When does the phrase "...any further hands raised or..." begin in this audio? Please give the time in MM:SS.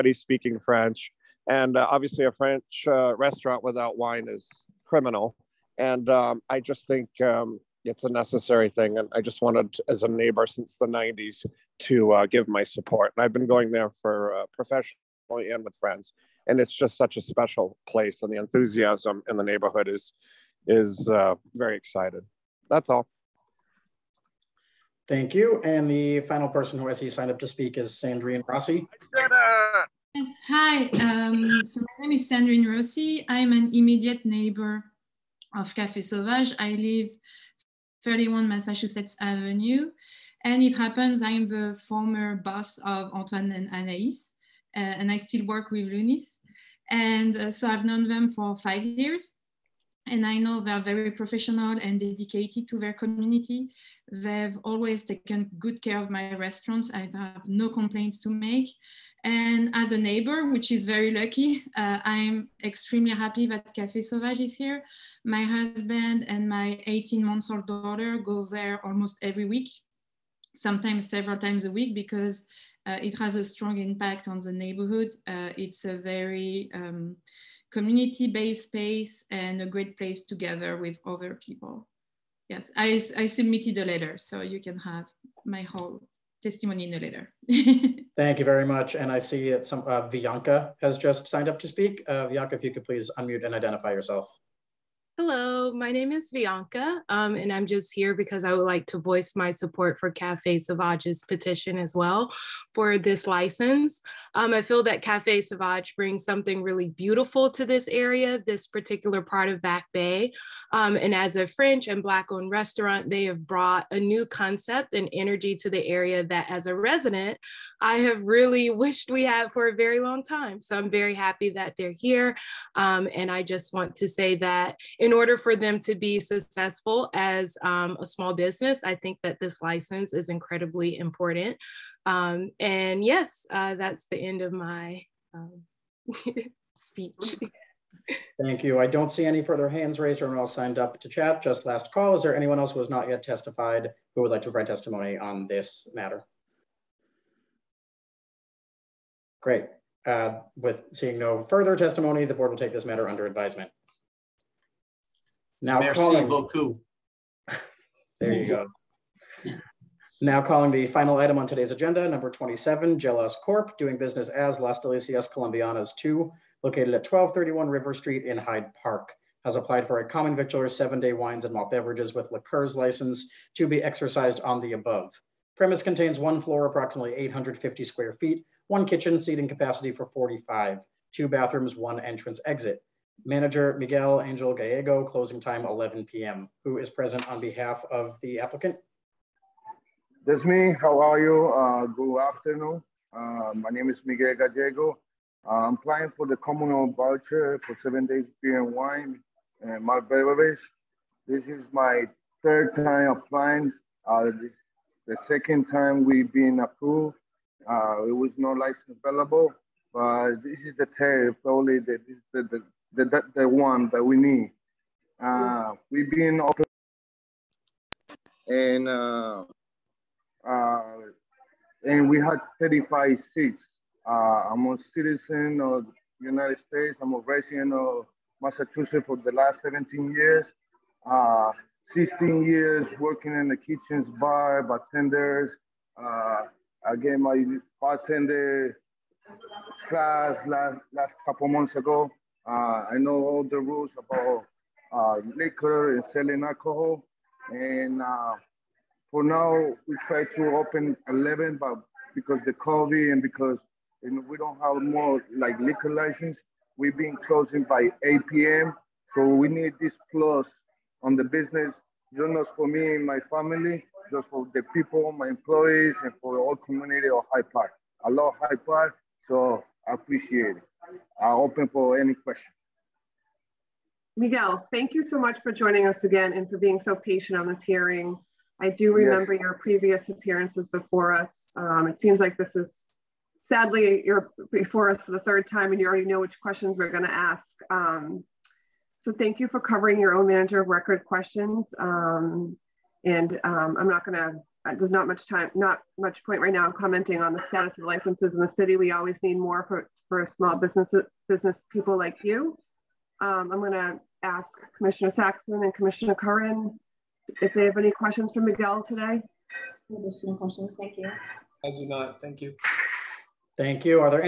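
02:19.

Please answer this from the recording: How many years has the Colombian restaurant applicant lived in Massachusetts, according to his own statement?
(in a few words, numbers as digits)
17.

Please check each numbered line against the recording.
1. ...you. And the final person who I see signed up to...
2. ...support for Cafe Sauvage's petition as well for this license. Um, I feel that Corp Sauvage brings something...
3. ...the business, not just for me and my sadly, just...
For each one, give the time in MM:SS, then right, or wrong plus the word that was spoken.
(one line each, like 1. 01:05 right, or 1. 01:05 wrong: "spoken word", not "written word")
1. 00:25 right
2. 01:39 wrong: "Cafe", not "Corp"
3. 04:21 wrong: "family", not "sadly".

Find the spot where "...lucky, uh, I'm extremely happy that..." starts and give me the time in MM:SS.
01:01.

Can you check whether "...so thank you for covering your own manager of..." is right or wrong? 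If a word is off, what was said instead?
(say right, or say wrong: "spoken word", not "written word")
right.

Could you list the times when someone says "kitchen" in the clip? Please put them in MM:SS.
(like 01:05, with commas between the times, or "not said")
02:58, 03:53.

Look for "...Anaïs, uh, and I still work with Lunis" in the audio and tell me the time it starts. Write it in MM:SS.
00:43.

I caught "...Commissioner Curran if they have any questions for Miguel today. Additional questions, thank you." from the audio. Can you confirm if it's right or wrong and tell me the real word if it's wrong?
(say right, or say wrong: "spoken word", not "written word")
right.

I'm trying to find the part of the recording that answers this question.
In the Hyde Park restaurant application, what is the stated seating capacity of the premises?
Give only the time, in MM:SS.
02:59.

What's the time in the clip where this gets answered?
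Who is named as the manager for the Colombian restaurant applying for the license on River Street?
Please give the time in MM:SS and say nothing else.
03:03.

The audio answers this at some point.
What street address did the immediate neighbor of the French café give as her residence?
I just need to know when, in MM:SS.
00:38.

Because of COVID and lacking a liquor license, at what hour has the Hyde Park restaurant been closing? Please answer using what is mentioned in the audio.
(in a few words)
8 p.m.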